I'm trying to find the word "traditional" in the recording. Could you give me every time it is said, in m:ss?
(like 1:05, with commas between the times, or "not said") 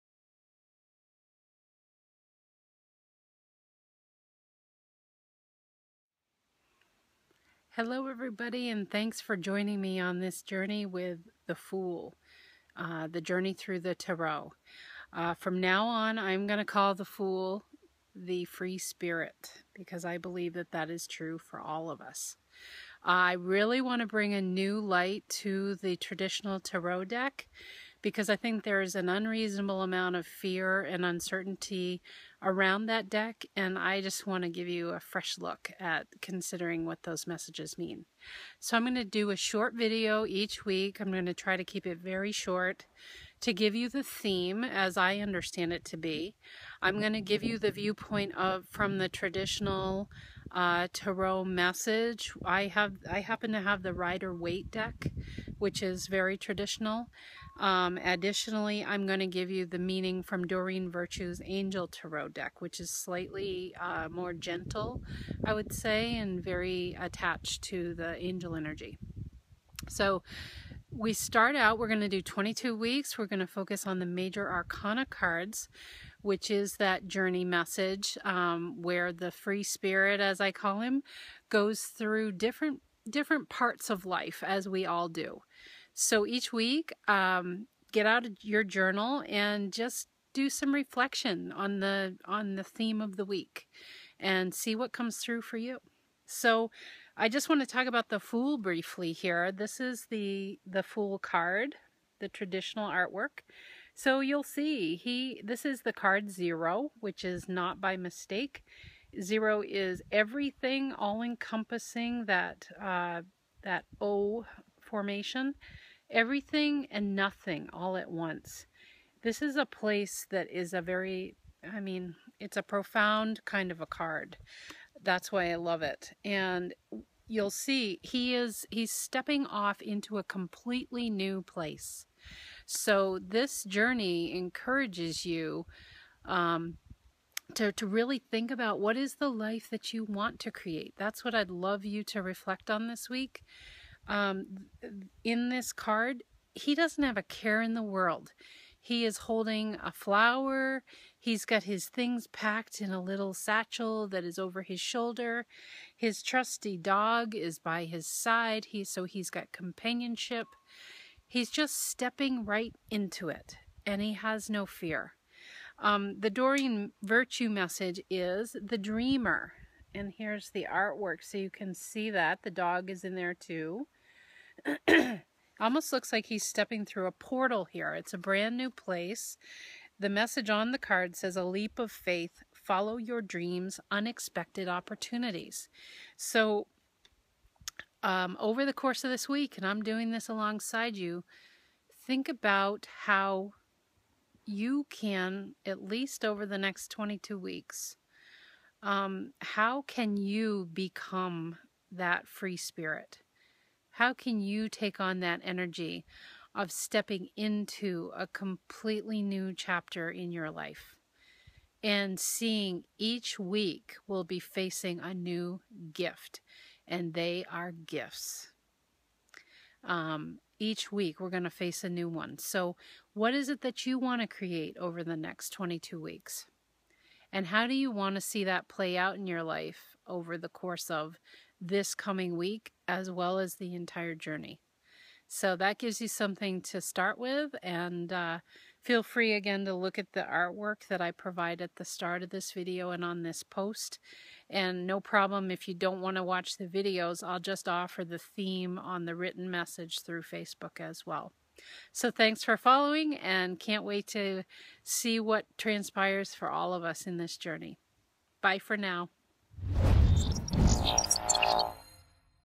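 0:25, 0:49, 0:56, 1:42.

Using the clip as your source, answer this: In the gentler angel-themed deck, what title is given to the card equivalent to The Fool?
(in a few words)
the dreamer.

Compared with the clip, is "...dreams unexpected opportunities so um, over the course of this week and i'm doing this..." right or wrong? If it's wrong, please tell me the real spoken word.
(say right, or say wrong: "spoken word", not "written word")
right.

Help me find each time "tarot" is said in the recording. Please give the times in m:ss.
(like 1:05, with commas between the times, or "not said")
0:13, 0:26, 0:50, 1:01.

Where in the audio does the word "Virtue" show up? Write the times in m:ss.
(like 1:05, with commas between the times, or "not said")
1:00, 2:47.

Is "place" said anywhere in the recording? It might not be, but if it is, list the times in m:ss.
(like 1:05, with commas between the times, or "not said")
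1:59, 2:11, 2:58.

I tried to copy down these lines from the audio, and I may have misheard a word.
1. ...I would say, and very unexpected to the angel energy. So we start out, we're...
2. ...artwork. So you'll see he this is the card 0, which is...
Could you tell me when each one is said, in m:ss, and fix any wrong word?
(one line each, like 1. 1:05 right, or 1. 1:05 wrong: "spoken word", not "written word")
1. 1:05 wrong: "attached", not "unexpected"
2. 1:42 right.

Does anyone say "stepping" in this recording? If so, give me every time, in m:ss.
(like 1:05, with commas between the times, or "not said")
2:08, 2:41, 2:56, 3:26.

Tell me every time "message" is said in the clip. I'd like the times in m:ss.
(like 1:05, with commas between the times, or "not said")
0:37, 0:51, 1:17, 2:47, 3:00, 4:09.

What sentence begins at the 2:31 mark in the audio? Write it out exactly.
He's got his things packed in a little satchel that is over his shoulder.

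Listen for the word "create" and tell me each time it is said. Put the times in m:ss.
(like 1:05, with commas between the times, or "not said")
2:20, 3:44.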